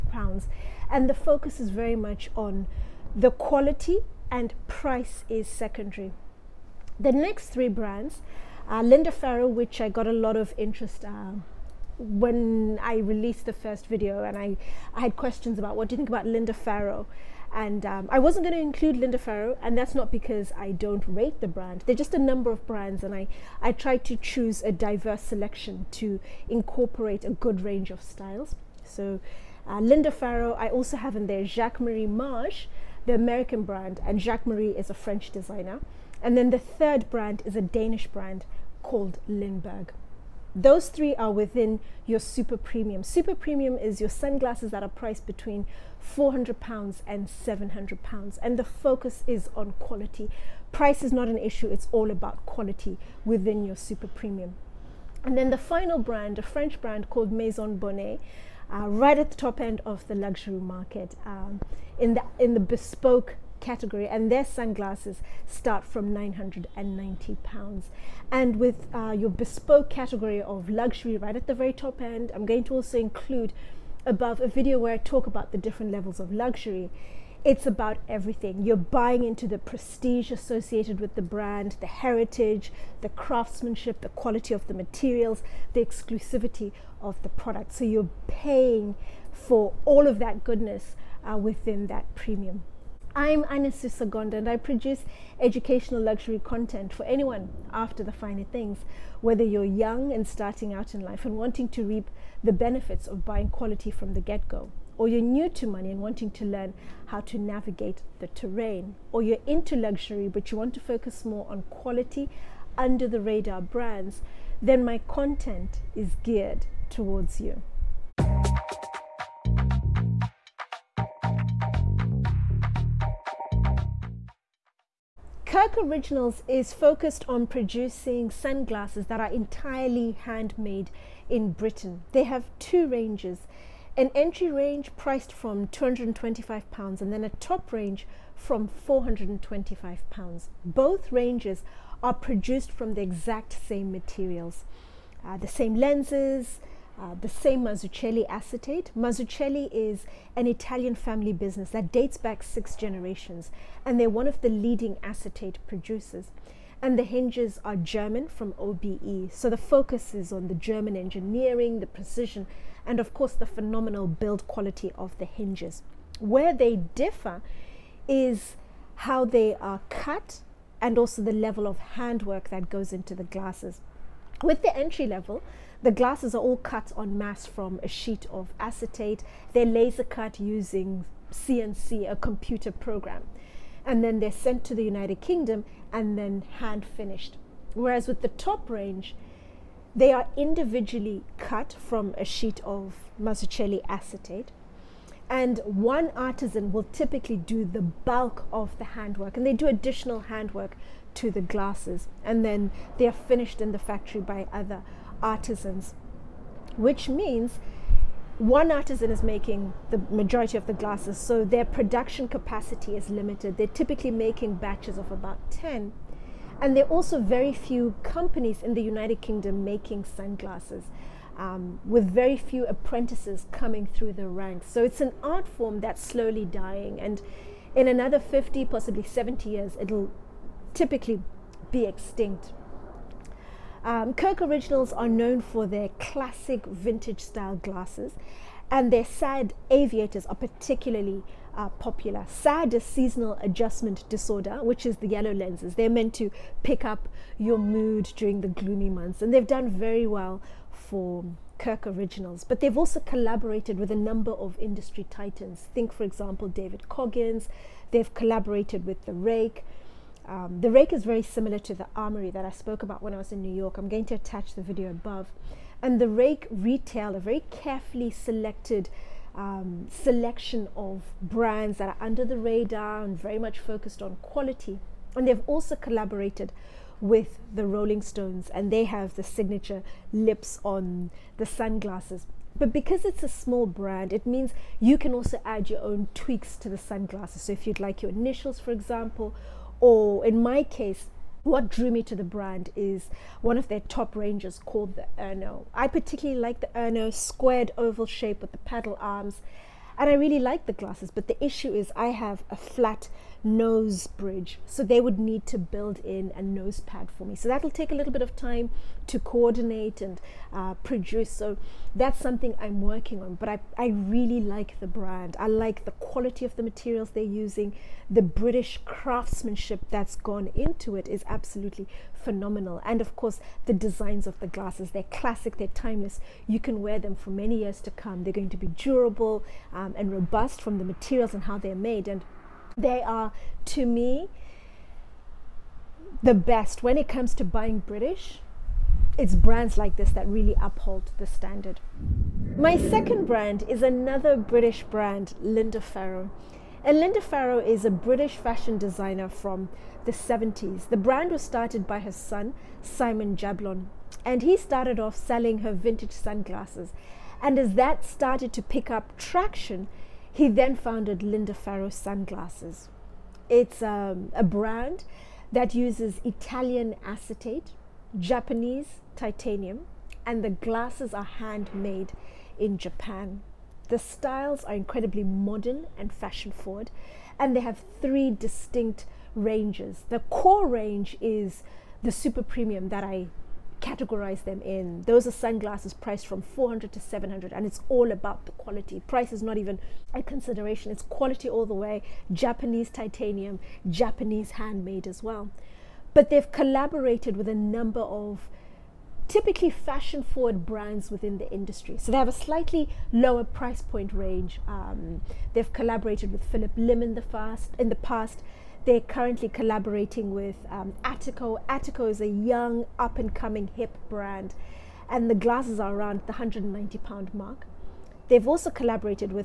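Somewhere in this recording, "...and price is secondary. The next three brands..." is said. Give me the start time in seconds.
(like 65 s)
4 s.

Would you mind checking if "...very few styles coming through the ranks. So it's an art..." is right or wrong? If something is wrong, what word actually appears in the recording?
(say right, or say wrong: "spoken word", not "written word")
wrong: "apprentices", not "styles".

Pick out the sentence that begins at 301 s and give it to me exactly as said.
But the issue is, I have a flat nose bridge.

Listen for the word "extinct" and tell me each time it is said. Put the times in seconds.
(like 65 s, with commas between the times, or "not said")
231 s.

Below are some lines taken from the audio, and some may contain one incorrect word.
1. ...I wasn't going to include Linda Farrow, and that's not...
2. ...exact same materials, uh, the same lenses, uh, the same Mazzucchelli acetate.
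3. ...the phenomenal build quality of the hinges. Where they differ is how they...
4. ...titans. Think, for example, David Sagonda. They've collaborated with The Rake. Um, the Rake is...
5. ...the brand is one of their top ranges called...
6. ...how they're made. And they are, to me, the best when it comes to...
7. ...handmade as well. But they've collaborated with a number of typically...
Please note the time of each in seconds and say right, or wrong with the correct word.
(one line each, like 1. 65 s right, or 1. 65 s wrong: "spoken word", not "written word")
1. 18 s right
2. 143 s right
3. 163 s right
4. 255 s wrong: "Coggins", not "Sagonda"
5. 292 s right
6. 331 s right
7. 394 s right.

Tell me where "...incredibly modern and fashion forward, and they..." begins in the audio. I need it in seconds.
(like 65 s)
374 s.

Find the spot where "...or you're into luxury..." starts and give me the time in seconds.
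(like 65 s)
109 s.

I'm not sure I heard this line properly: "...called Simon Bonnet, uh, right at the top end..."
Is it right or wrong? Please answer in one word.
wrong.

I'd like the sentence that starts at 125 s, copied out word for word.
Kirk Originals is focused on producing sunglasses that are entirely handmade in Britain.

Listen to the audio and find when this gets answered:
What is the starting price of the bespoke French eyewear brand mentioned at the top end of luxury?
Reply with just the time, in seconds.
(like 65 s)
66 s.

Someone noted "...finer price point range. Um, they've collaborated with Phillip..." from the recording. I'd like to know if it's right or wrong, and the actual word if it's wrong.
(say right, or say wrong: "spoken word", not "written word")
wrong: "lower", not "finer".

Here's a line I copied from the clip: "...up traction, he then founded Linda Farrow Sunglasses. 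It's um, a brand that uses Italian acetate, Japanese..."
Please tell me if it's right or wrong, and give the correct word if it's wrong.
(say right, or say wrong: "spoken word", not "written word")
right.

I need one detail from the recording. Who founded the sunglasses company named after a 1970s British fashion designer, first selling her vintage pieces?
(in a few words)
Simon Jablon.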